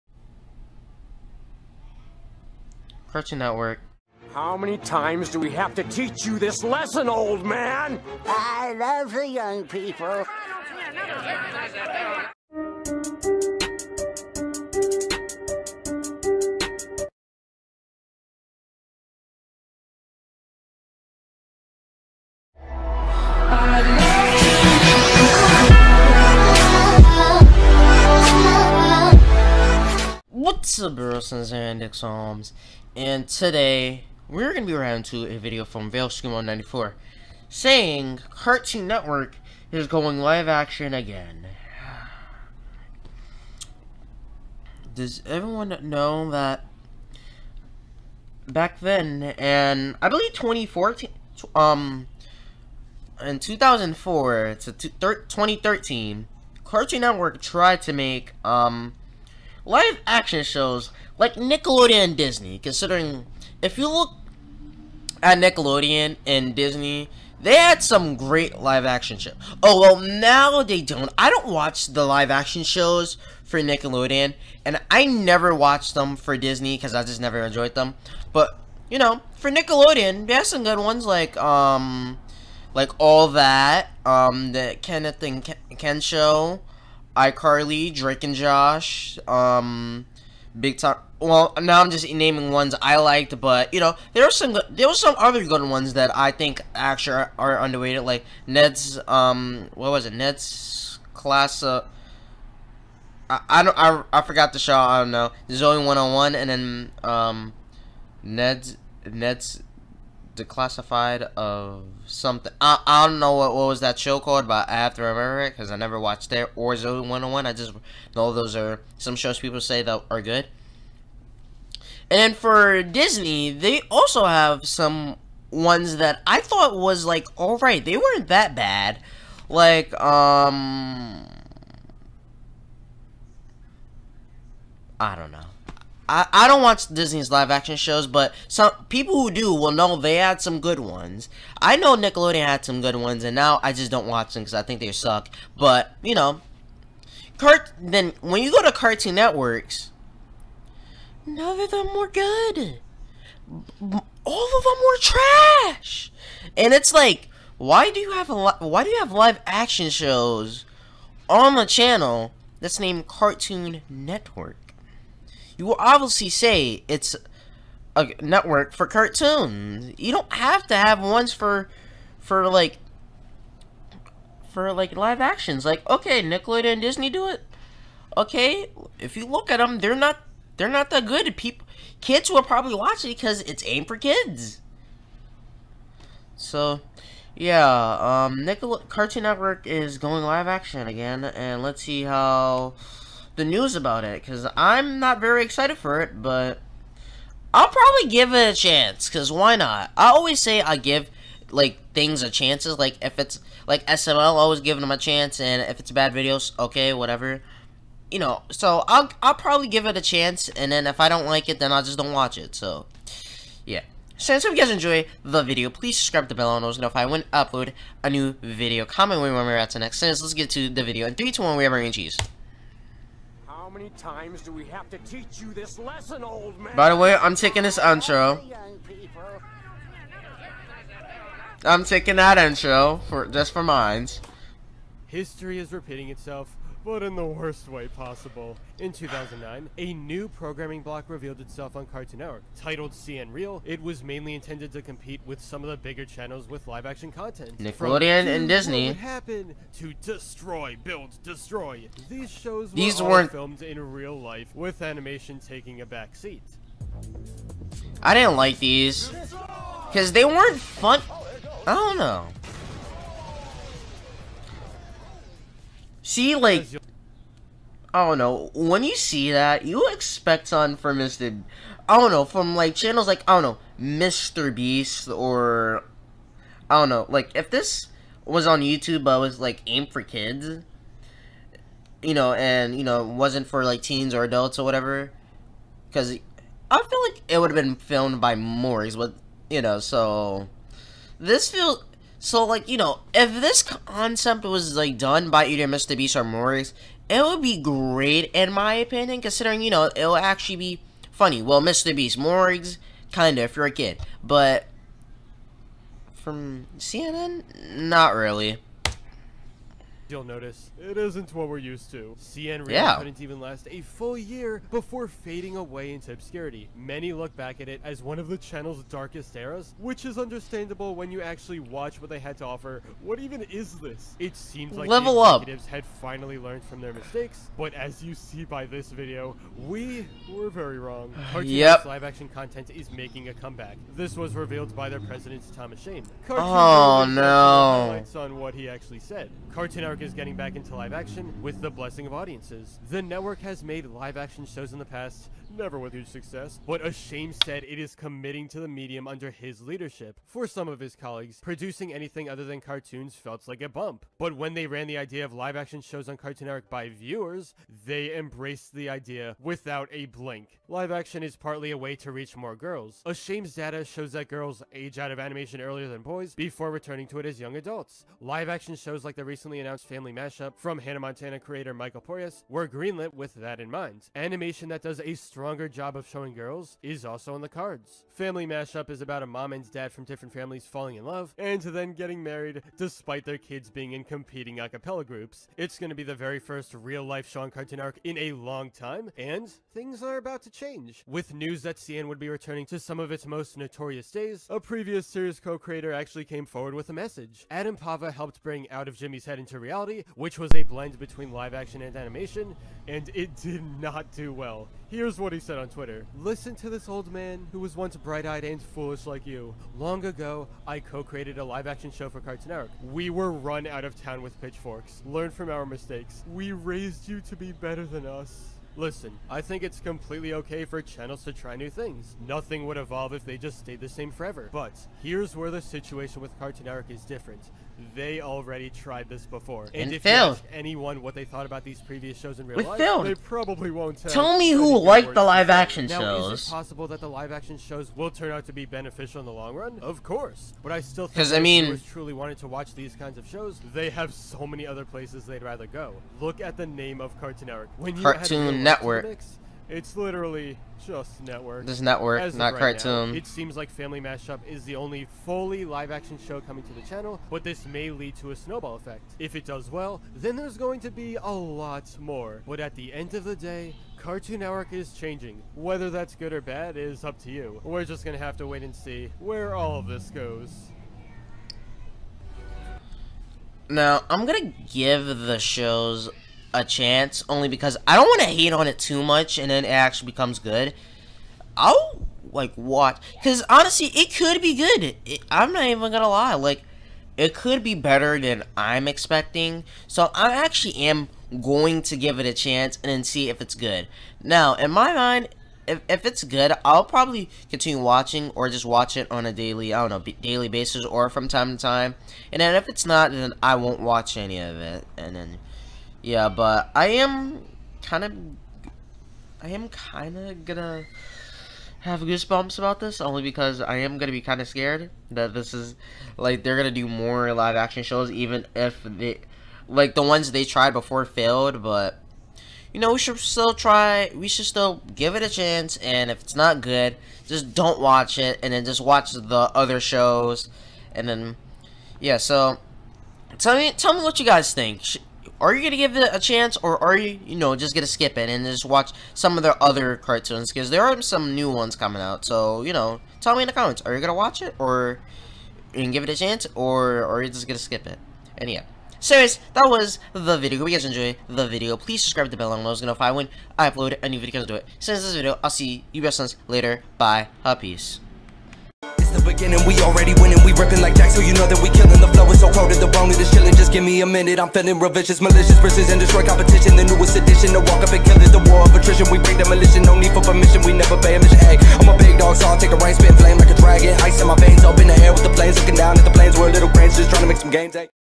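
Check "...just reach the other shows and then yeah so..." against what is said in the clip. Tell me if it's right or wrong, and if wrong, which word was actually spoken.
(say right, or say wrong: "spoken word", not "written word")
wrong: "watch", not "reach".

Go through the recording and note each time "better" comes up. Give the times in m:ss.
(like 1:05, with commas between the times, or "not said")
6:57, 8:07.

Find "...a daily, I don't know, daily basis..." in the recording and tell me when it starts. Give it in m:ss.
8:19.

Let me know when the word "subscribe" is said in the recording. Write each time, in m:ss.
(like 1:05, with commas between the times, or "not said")
3:35, 9:12.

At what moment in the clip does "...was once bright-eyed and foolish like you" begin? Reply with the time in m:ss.
6:47.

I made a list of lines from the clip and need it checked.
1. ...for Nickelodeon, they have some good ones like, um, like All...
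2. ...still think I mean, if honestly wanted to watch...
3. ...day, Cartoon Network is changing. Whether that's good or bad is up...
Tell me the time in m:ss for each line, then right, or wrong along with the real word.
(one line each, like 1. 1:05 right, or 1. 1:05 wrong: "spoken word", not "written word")
1. 1:19 right
2. 7:20 wrong: "truly", not "honestly"
3. 7:43 right.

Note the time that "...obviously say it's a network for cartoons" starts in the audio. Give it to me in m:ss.
2:45.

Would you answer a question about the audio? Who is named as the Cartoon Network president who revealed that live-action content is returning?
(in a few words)
Tom Ascheim.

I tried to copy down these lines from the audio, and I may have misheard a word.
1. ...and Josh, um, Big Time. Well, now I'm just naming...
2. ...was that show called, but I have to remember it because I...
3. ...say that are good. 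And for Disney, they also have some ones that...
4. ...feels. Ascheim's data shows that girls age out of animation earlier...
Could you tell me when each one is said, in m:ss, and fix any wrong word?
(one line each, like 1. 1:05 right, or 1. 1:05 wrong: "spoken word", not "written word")
1. 1:28 right
2. 1:53 right
3. 1:59 right
4. 6:02 wrong: "girls", not "feels".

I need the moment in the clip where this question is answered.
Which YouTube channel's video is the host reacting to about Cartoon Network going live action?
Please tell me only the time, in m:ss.
0:35.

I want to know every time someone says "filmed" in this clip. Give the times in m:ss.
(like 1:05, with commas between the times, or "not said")
4:13, 4:47.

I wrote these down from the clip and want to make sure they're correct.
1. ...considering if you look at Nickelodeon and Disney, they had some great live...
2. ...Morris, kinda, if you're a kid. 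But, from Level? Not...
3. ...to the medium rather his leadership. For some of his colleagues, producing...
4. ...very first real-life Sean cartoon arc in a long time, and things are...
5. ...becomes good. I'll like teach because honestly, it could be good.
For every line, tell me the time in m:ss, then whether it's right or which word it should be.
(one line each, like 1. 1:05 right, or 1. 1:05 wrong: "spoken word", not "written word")
1. 1:02 right
2. 5:02 wrong: "CNN", not "Level"
3. 5:48 wrong: "under", not "rather"
4. 6:26 right
5. 8:00 wrong: "watch", not "teach".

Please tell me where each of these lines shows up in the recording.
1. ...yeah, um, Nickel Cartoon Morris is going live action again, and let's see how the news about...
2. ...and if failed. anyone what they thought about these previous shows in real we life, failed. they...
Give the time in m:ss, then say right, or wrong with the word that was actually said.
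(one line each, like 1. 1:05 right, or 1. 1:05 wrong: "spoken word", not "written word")
1. 3:07 wrong: "Network", not "Morris"
2. 7:09 right.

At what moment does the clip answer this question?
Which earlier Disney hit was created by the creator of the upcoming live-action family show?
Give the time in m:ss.
6:10.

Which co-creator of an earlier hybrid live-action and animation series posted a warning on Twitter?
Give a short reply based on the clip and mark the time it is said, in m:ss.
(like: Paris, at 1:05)
Adam Pava, at 6:37.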